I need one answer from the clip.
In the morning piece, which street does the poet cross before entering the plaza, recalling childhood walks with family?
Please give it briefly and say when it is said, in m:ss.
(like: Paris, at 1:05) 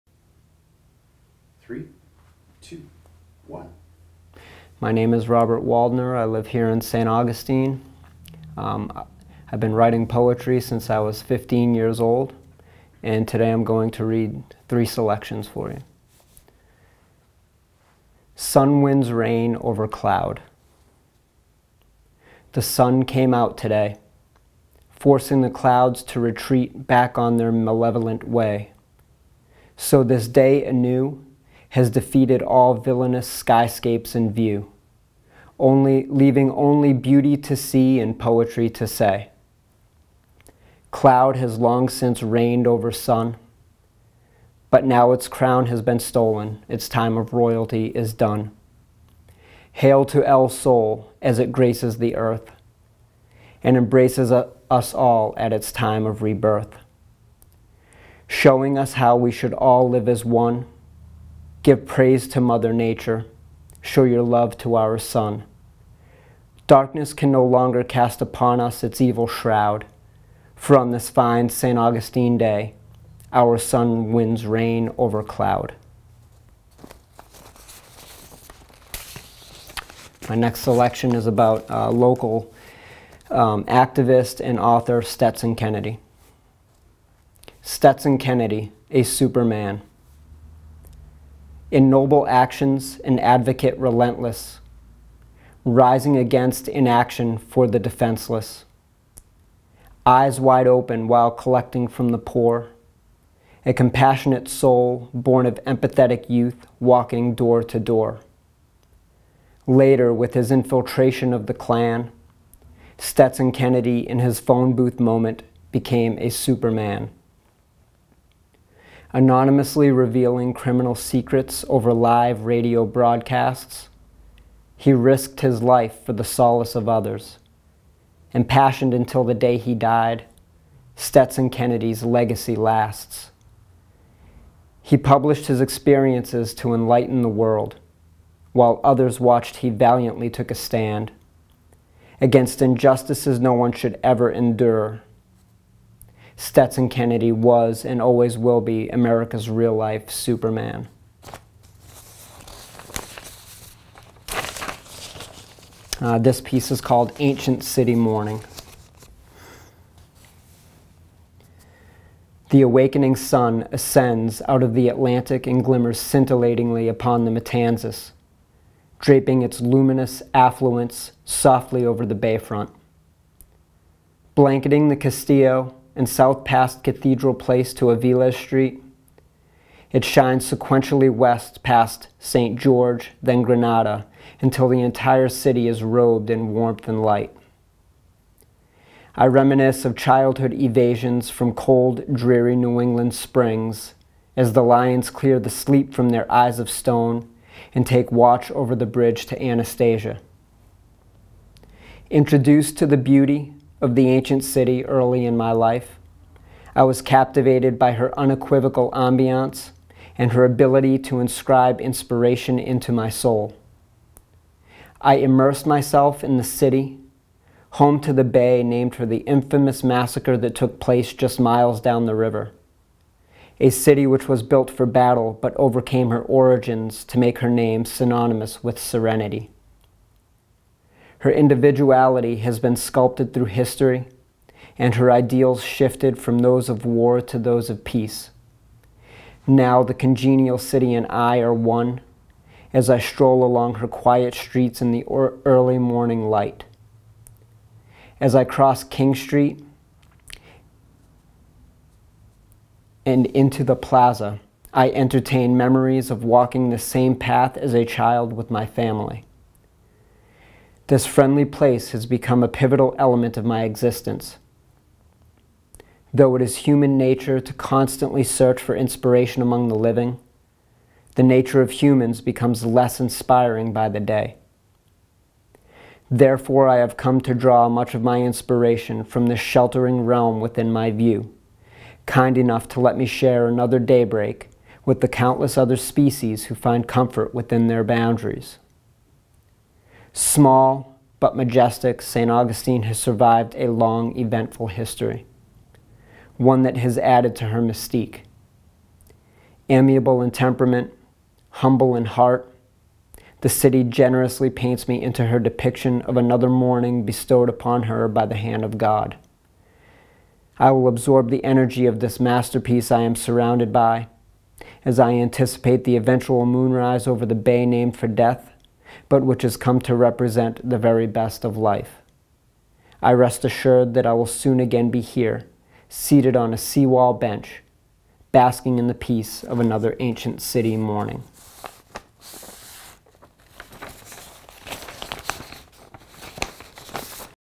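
King Street, at 4:08.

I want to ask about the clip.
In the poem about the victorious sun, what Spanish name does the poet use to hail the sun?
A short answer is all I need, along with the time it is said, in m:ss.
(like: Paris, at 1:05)
El Sol, at 0:50.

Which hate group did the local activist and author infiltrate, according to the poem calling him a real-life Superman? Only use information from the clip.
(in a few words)
the Klan.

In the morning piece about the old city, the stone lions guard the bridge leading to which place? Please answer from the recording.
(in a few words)
Anastasia.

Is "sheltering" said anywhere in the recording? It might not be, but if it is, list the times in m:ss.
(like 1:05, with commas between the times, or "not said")
4:39.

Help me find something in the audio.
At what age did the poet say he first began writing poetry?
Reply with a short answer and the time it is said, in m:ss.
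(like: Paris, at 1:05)
15, at 0:11.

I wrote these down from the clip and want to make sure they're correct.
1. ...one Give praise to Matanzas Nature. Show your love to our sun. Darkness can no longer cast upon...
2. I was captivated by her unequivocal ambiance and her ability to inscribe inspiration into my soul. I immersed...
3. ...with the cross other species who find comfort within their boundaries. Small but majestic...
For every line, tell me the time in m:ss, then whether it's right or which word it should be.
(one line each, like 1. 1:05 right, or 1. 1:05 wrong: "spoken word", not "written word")
1. 1:00 wrong: "Mother", not "Matanzas"
2. 3:26 right
3. 4:44 wrong: "countless", not "cross".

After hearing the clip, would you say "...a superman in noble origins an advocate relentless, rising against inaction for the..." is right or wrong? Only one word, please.
wrong.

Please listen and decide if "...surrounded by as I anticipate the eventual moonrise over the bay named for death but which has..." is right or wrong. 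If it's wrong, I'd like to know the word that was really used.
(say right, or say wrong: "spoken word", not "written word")
right.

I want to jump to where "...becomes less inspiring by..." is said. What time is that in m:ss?
4:32.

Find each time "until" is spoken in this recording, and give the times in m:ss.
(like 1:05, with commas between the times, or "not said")
2:08, 3:04.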